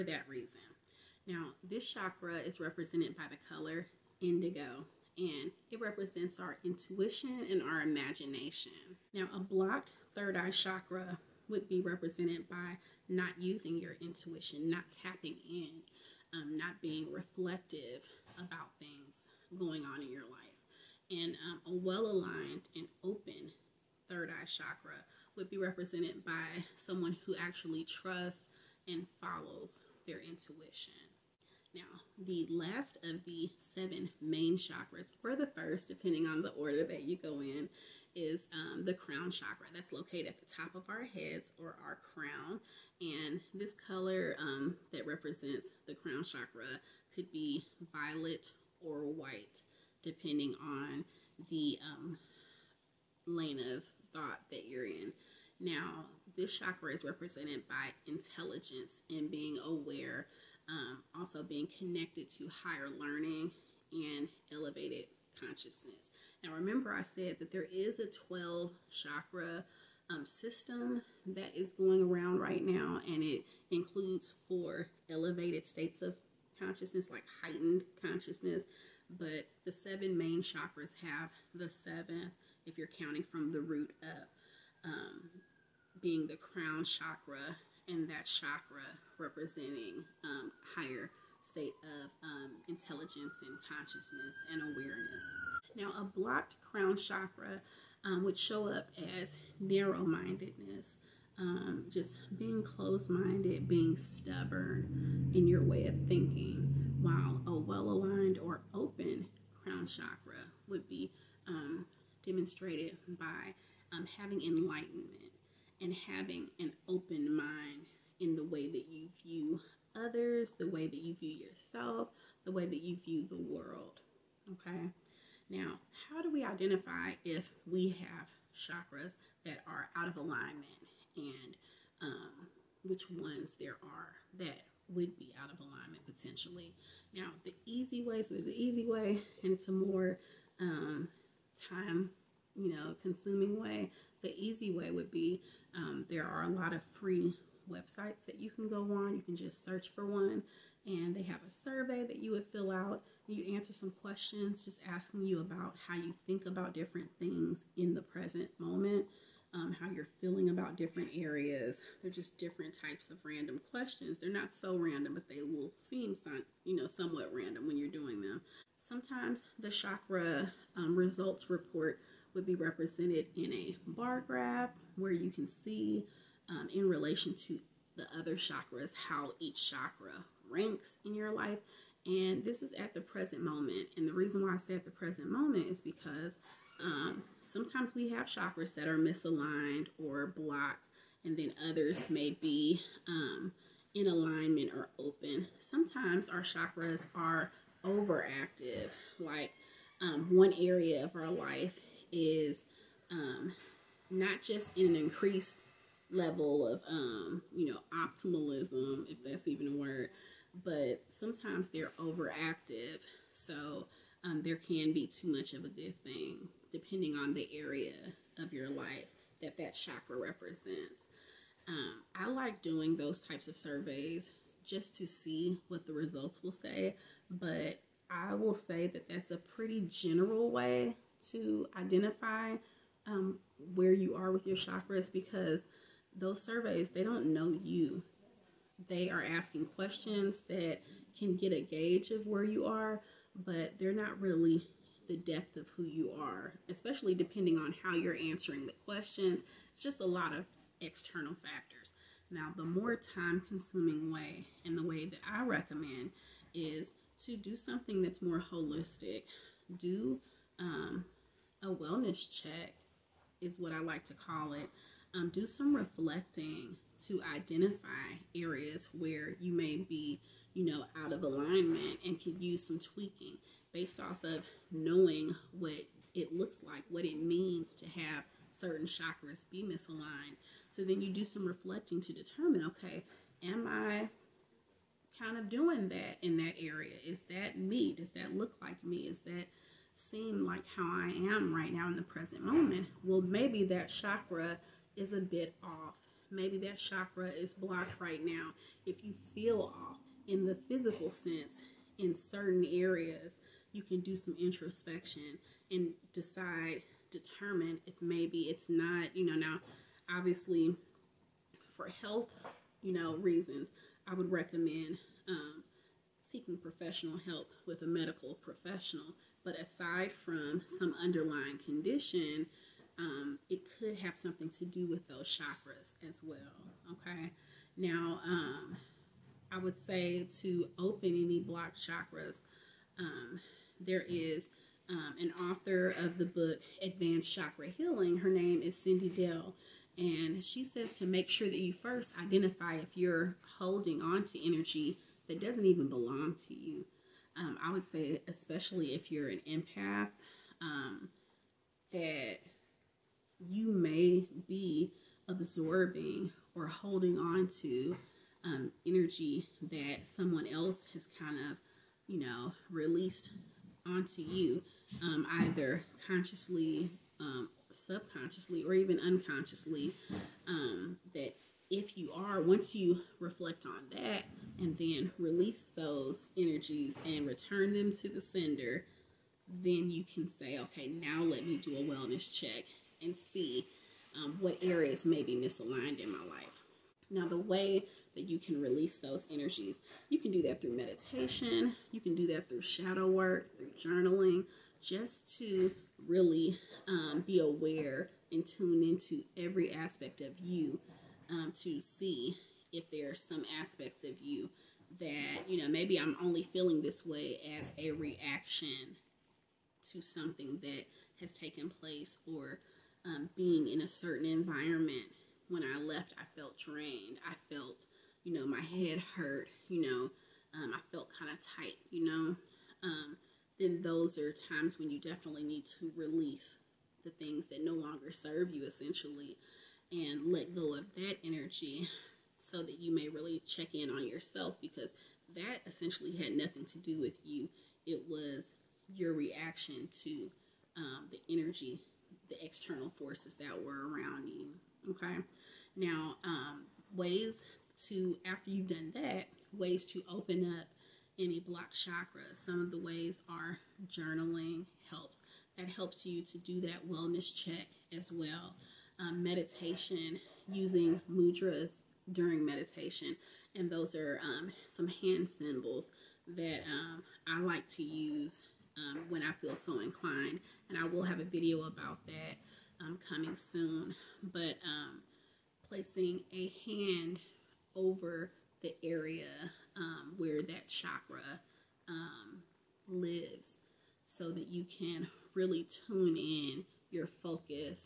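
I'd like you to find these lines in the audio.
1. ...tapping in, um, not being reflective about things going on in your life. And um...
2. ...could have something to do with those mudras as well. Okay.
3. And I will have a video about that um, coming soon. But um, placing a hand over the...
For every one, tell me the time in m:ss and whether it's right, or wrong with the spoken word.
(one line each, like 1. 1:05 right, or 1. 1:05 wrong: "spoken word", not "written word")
1. 0:15 right
2. 5:23 wrong: "chakras", not "mudras"
3. 7:50 right.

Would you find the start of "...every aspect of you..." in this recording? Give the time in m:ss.
6:39.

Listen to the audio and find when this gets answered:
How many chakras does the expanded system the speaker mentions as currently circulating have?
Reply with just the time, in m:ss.
1:08.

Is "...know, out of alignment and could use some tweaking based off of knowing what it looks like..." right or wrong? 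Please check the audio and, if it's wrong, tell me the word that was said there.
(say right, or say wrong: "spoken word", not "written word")
right.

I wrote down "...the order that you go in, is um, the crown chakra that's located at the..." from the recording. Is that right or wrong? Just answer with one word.
right.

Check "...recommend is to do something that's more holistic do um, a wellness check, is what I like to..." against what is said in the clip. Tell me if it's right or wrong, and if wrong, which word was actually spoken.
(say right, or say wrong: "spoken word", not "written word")
right.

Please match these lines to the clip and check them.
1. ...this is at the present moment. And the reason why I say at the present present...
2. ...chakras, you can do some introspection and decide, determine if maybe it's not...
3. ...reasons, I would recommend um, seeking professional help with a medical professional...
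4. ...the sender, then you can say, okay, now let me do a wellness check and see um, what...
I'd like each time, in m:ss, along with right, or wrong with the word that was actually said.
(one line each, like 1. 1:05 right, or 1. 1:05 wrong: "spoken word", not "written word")
1. 3:02 wrong: "moment", not "present"
2. 5:02 wrong: "areas", not "chakras"
3. 5:13 right
4. 6:18 right.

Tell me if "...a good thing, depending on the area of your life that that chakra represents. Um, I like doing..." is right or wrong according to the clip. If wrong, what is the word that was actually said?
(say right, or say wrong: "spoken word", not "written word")
right.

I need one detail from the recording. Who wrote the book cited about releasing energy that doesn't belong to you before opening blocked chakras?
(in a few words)
Cyndi Dale.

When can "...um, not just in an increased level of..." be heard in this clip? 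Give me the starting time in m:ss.
3:23.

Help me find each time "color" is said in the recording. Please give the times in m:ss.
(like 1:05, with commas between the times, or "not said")
0:03, 0:43.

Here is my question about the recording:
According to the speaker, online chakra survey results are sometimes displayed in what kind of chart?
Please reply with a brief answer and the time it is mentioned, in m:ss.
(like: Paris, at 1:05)
Bar graph, at 2:53.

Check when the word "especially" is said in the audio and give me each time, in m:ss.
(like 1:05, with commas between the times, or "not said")
4:06, 5:48.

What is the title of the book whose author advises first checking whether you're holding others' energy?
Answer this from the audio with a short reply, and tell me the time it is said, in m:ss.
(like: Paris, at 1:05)
Advanced Chakra Healing, at 5:36.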